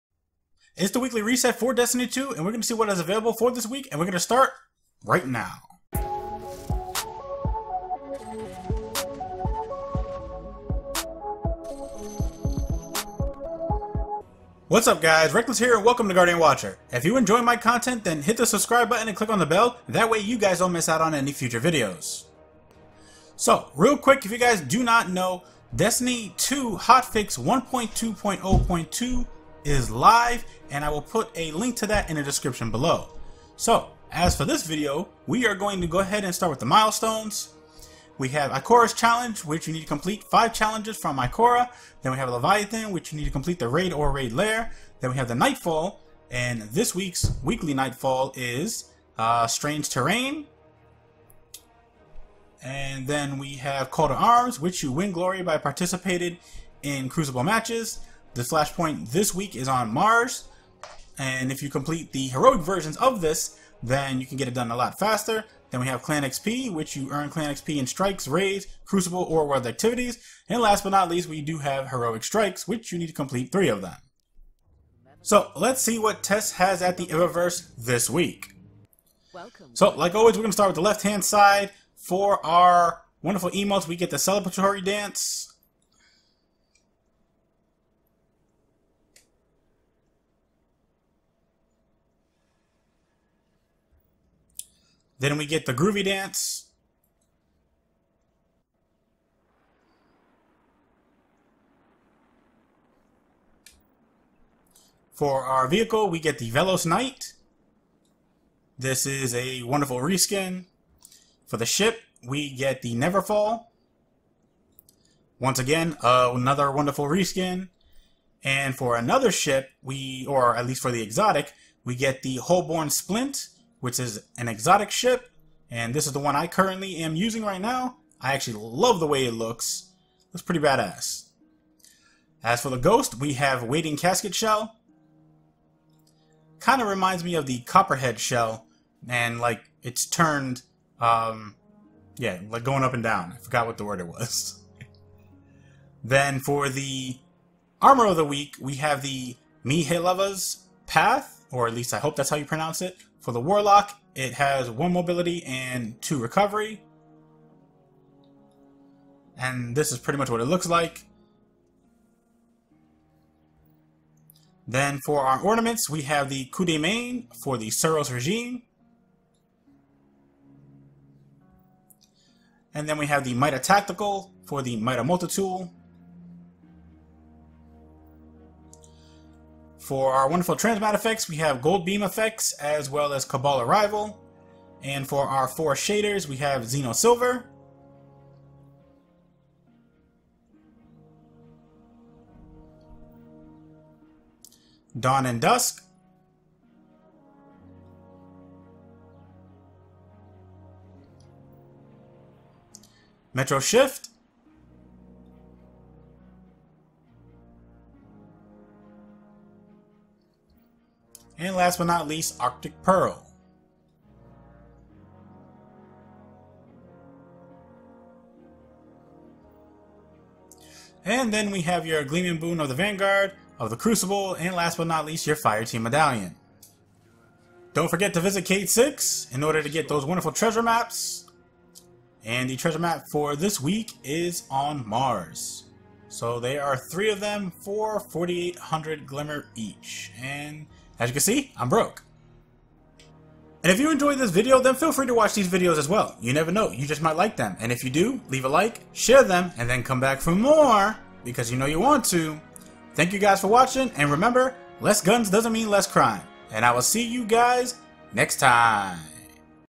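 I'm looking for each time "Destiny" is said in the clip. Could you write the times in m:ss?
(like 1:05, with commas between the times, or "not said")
0:01, 0:25.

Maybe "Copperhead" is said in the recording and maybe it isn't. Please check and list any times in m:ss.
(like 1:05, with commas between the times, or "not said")
2:17.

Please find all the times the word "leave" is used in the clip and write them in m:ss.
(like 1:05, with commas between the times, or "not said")
4:08.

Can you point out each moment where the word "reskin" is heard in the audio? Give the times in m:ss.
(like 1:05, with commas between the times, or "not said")
1:49, 1:57.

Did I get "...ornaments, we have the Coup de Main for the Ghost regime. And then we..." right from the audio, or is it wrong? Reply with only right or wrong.
wrong.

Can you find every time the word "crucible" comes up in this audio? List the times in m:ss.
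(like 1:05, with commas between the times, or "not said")
0:57, 1:08, 3:43.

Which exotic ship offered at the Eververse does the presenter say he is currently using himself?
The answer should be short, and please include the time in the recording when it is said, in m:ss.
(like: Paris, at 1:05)
Holborn Splint, at 2:02.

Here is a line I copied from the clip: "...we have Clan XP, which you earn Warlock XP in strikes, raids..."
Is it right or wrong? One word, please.
wrong.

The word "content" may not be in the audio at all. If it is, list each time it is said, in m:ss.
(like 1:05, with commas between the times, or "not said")
0:17.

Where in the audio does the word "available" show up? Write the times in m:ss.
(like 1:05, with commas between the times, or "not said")
0:03.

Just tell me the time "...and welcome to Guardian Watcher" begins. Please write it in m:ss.
0:15.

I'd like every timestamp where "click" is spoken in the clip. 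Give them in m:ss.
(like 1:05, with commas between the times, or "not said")
0:19.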